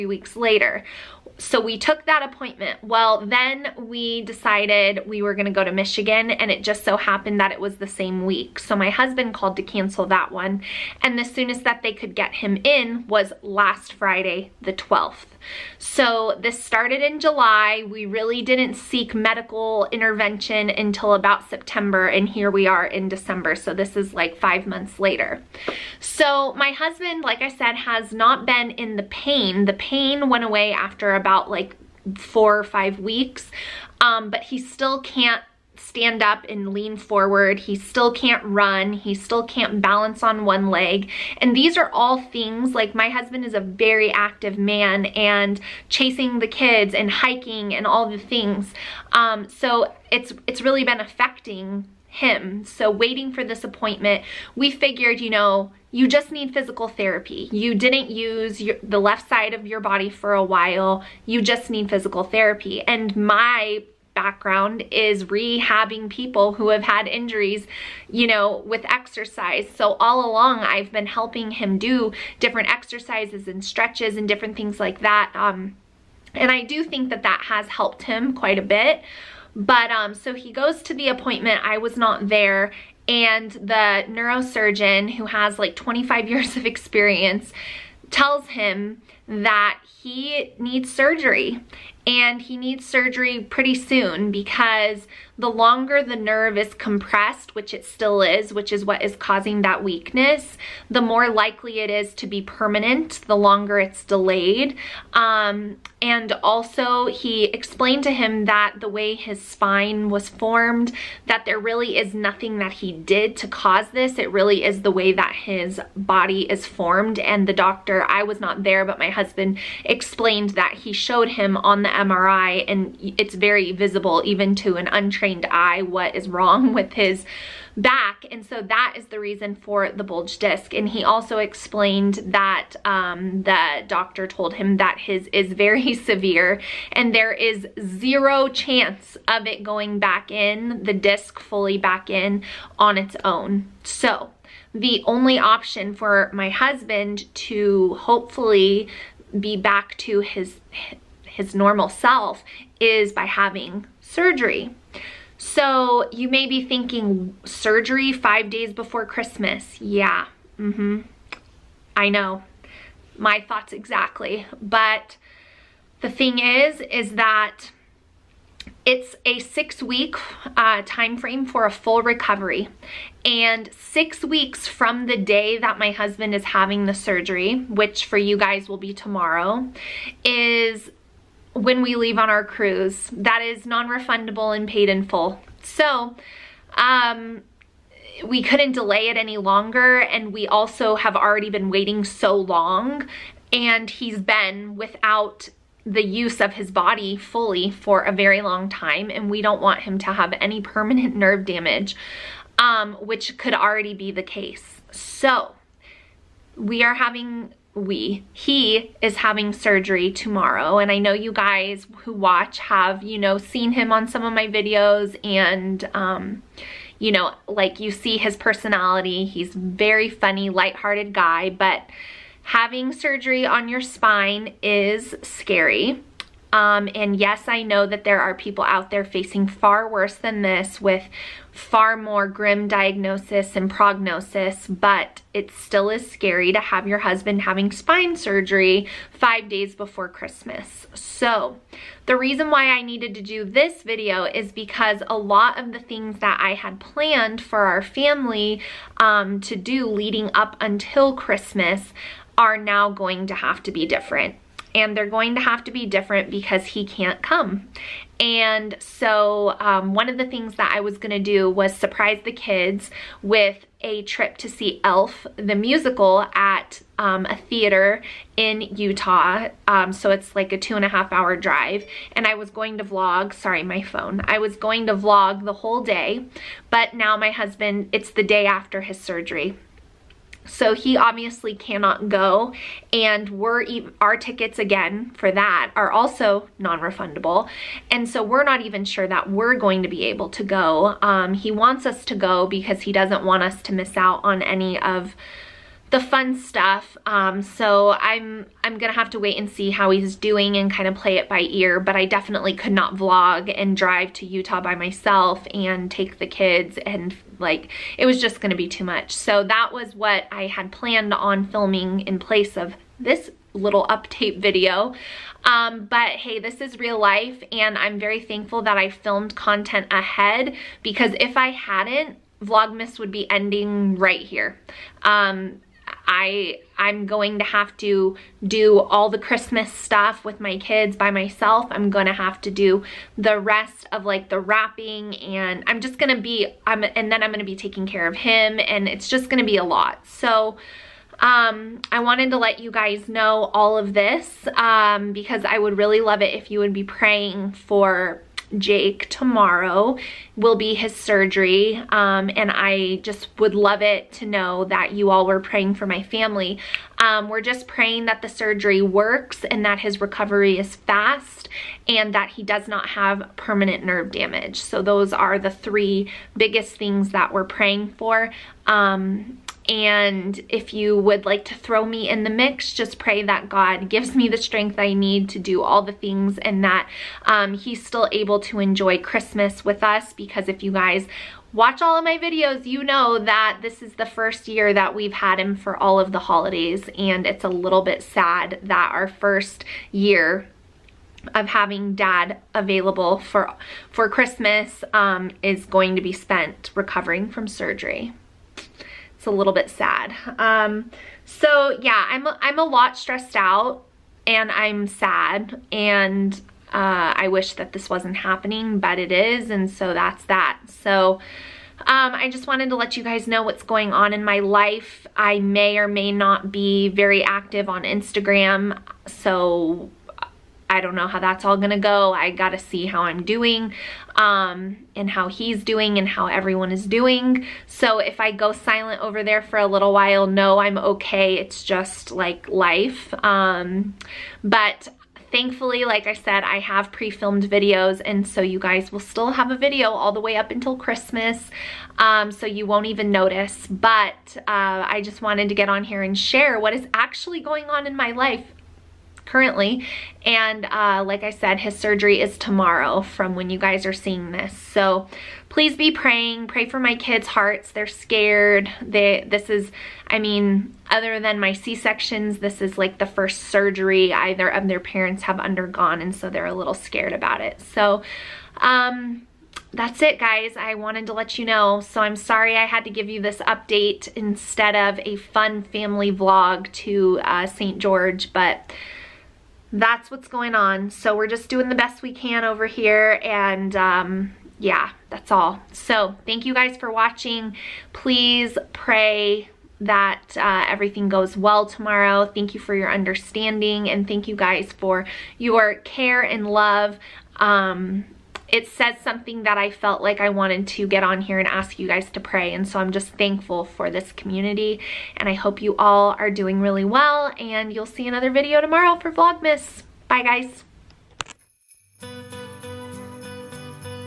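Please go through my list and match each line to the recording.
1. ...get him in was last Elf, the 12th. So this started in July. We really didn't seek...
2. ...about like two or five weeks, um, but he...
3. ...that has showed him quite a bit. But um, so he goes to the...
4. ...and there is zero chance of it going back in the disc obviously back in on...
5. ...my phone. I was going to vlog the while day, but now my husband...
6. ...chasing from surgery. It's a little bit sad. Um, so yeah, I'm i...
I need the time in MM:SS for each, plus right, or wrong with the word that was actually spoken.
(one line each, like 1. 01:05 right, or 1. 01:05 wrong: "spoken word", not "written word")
1. 00:12 wrong: "Friday", not "Elf"
2. 00:31 wrong: "four", not "two"
3. 01:17 wrong: "helped", not "showed"
4. 02:16 wrong: "fully", not "obviously"
5. 04:33 wrong: "whole", not "while"
6. 06:36 wrong: "recovering", not "chasing".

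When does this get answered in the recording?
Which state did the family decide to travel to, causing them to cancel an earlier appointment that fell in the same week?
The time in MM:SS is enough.
00:05.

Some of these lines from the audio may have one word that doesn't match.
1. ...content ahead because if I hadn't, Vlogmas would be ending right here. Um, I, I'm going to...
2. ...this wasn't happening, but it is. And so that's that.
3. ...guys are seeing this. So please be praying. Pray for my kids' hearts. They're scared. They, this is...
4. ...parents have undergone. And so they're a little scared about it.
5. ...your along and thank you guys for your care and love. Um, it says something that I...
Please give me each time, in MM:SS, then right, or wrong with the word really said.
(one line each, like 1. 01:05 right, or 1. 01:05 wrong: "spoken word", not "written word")
1. 05:19 right
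2. 06:47 right
3. 07:33 right
4. 07:44 right
5. 08:12 wrong: "understanding", not "along".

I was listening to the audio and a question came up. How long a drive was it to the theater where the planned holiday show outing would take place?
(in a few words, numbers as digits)
2.5 hours.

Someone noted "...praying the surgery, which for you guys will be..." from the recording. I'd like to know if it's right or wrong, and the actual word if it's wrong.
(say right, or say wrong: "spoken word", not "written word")
wrong: "having", not "praying".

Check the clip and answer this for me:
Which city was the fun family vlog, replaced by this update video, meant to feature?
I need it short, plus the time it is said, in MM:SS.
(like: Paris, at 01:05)
St. George, at 07:57.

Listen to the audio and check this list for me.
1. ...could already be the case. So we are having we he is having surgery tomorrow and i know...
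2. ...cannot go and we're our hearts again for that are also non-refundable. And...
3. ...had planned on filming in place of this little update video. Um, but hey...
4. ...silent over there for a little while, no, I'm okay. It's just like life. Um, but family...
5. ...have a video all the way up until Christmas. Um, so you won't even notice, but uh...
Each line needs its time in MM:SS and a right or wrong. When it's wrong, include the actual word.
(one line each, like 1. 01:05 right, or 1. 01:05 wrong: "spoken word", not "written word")
1. 03:23 right
2. 04:41 wrong: "tickets", not "hearts"
3. 05:10 right
4. 07:08 wrong: "thankfully", not "family"
5. 07:19 right.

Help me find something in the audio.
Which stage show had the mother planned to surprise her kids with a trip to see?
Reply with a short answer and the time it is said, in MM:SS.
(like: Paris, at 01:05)
Elf, the musical, at 04:24.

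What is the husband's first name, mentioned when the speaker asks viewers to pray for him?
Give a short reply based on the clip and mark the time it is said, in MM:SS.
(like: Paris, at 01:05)
Jake, at 05:48.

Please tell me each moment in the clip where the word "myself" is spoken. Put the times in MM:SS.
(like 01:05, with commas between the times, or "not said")
05:04, 05:31.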